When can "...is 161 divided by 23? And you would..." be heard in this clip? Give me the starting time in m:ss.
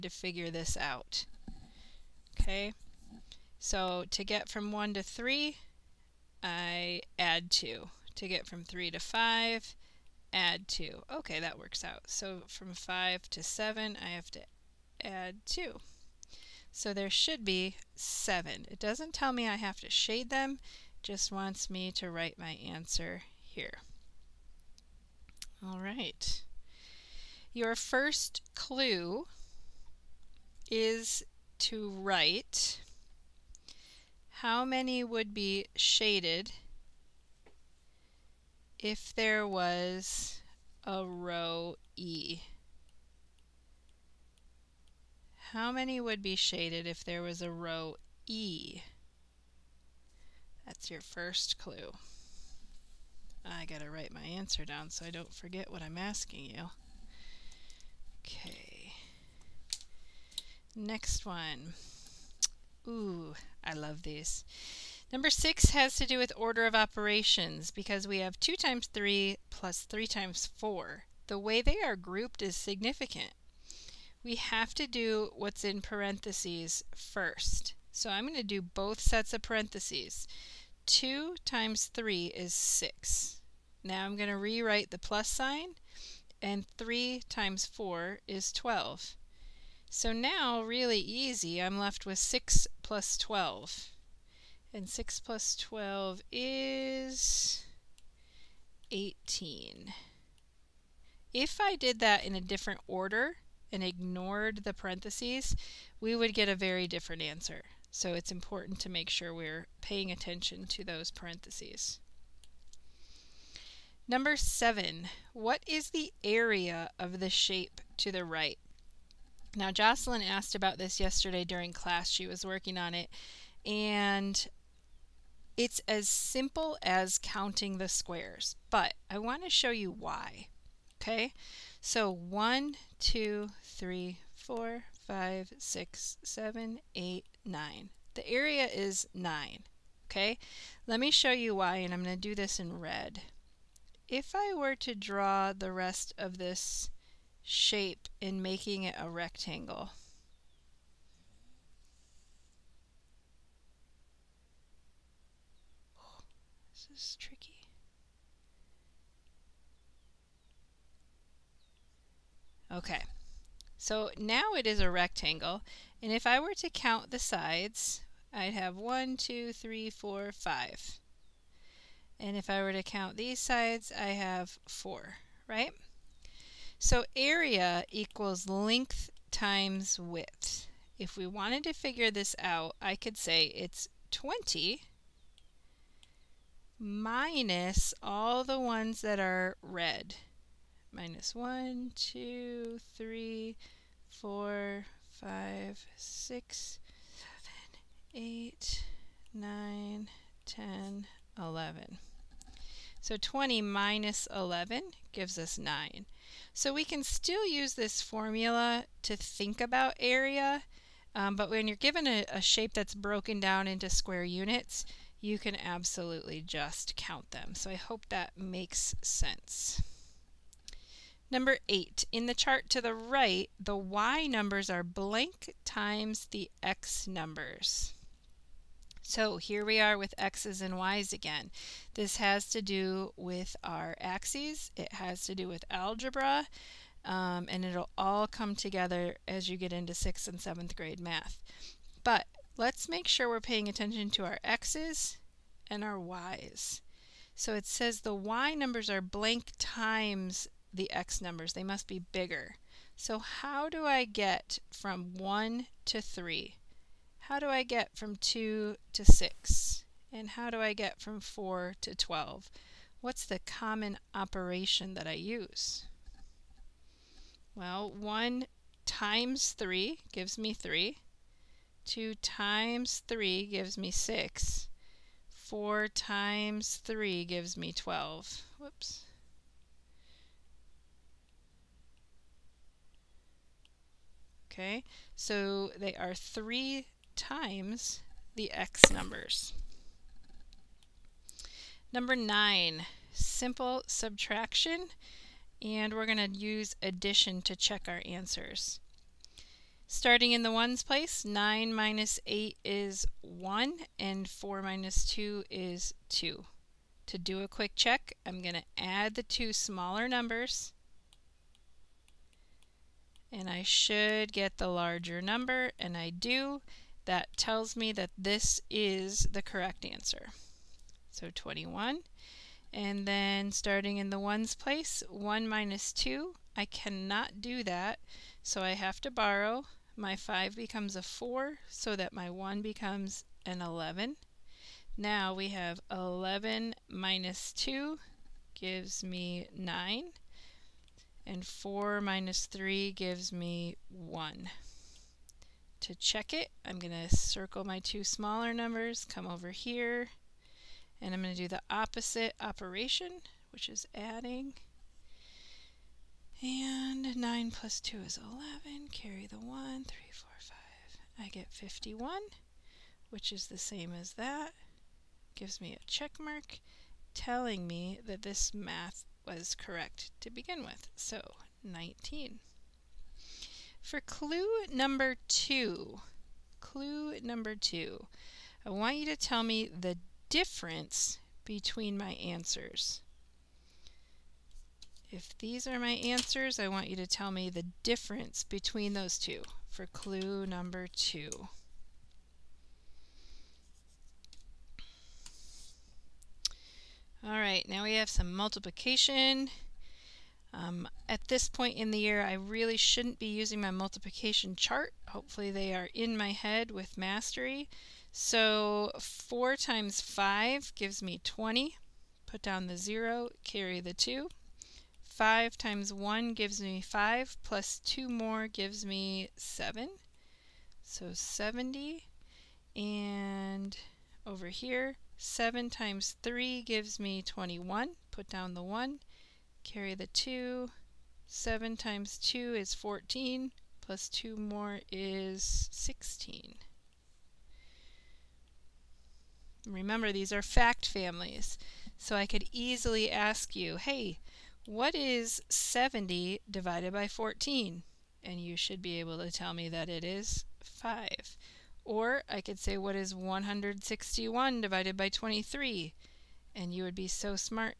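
7:32.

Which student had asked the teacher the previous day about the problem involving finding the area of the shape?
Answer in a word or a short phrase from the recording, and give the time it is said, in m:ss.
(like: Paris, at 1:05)
Jocelyn, at 1:59.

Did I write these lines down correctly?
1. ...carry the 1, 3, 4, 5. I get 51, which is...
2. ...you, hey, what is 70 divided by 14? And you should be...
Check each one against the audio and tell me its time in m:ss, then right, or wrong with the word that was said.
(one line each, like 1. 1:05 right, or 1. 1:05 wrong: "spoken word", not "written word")
1. 5:58 right
2. 7:23 right.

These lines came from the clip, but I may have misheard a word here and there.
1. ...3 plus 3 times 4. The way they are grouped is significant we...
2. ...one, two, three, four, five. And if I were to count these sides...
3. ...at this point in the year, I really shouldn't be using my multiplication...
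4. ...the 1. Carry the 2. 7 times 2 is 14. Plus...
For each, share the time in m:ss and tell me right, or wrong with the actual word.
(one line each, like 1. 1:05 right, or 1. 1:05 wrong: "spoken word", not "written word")
1. 1:08 right
2. 2:48 right
3. 6:41 right
4. 7:08 right.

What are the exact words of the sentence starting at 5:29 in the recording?
My 5 becomes a 4, so that my 1 becomes an 11.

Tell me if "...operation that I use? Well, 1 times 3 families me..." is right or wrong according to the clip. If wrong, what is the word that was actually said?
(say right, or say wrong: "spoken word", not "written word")
wrong: "gives", not "families".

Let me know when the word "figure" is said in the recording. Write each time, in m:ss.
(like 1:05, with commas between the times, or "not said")
0:00, 3:01.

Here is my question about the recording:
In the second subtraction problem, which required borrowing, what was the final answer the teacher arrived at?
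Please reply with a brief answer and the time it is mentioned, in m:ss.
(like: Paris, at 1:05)
19, at 6:10.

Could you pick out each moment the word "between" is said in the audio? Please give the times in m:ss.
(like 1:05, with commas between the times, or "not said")
6:21, 6:28.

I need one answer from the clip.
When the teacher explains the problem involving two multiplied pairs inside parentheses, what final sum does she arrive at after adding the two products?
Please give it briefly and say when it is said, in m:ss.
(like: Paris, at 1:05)
18, at 1:34.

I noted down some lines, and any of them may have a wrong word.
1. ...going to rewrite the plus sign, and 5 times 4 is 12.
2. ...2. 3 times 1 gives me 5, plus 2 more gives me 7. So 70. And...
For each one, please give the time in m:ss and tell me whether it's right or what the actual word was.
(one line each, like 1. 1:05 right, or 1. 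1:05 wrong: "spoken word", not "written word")
1. 1:24 wrong: "3", not "5"
2. 6:53 wrong: "5", not "3".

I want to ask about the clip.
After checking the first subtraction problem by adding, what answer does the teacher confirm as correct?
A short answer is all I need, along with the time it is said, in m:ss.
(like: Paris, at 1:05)
21, at 5:21.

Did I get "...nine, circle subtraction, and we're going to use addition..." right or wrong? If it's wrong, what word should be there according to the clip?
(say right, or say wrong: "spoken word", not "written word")
wrong: "simple", not "circle".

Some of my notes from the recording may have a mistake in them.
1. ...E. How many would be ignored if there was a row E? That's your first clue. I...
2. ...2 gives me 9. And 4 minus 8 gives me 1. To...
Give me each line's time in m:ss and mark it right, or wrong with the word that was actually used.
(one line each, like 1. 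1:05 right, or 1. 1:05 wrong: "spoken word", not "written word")
1. 0:41 wrong: "shaded", not "ignored"
2. 5:37 wrong: "3", not "8".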